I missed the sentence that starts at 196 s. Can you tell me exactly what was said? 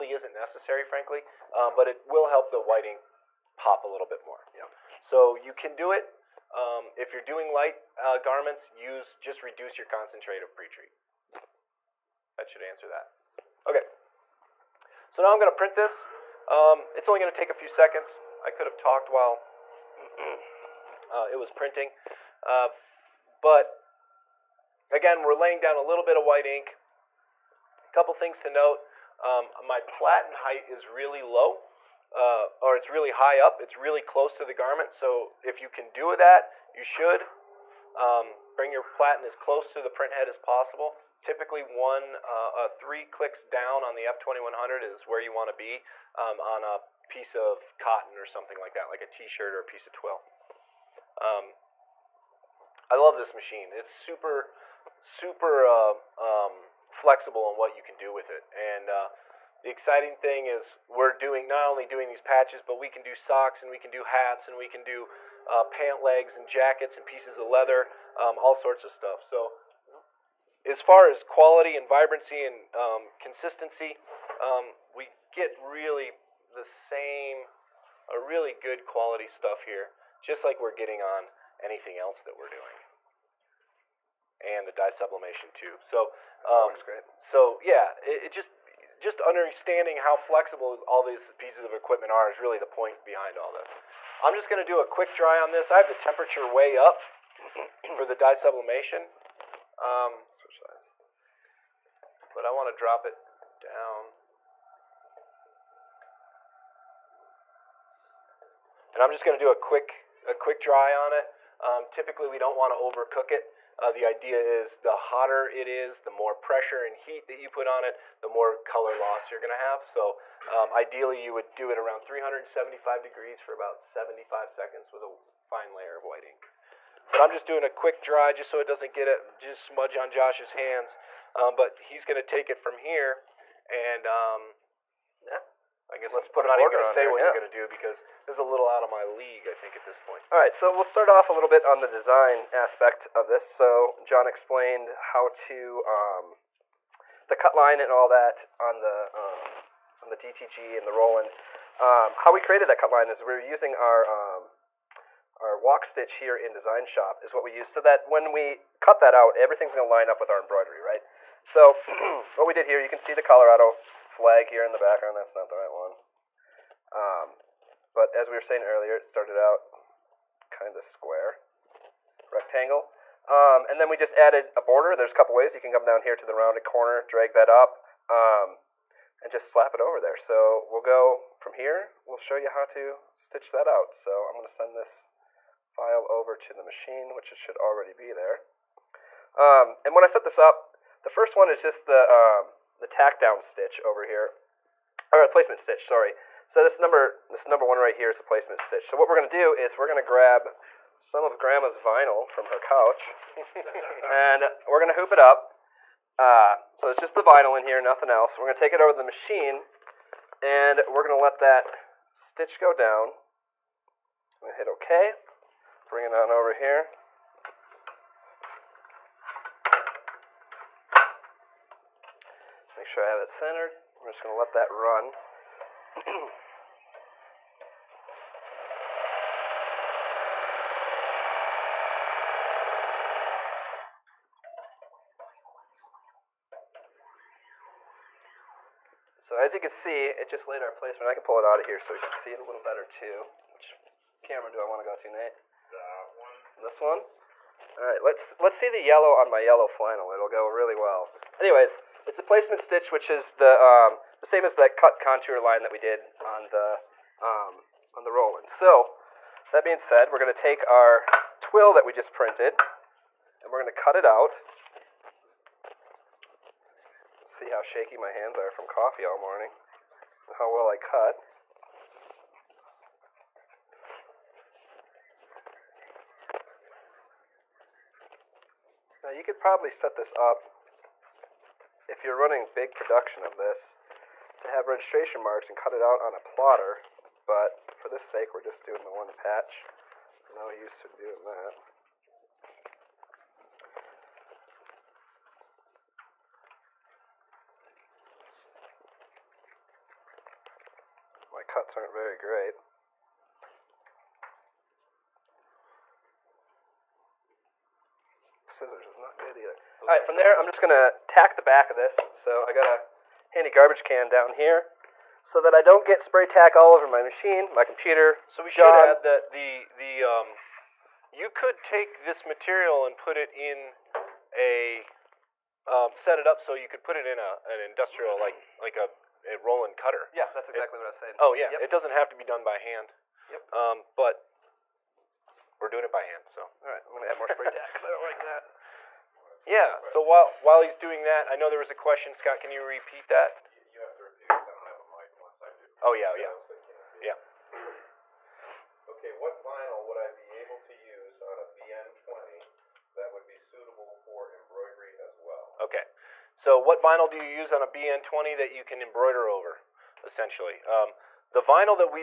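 So this number, this number one right here is the placement stitch.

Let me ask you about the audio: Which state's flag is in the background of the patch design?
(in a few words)
Colorado.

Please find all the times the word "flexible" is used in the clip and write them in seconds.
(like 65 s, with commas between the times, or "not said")
56 s, 90 s.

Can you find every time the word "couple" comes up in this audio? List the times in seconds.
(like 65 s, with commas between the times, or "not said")
27 s, 175 s.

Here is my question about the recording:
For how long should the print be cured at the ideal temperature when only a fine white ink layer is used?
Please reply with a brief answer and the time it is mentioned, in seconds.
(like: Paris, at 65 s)
75 seconds, at 123 s.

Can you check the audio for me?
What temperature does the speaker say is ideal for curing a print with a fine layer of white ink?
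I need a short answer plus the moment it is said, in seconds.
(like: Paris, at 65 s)
375 degrees, at 122 s.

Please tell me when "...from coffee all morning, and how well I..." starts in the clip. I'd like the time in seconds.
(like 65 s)
268 s.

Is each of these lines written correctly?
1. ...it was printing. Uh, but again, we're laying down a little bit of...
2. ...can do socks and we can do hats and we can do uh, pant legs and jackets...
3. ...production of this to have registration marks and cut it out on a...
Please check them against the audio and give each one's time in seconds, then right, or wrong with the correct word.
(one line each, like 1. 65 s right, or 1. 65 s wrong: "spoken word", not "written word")
1. 21 s right
2. 62 s right
3. 282 s right.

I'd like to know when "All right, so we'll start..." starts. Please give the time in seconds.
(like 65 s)
140 s.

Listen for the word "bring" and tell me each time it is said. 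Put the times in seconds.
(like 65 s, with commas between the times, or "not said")
38 s, 215 s.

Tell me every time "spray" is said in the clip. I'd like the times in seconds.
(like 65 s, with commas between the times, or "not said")
316 s, 337 s.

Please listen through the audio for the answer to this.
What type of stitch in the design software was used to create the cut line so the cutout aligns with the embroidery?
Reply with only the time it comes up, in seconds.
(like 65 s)
155 s.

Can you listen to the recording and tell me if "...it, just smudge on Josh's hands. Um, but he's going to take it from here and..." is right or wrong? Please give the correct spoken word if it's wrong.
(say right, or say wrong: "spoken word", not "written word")
right.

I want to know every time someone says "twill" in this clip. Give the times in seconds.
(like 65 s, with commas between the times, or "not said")
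49 s, 261 s.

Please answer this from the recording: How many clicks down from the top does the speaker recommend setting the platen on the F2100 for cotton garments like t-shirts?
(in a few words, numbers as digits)
3.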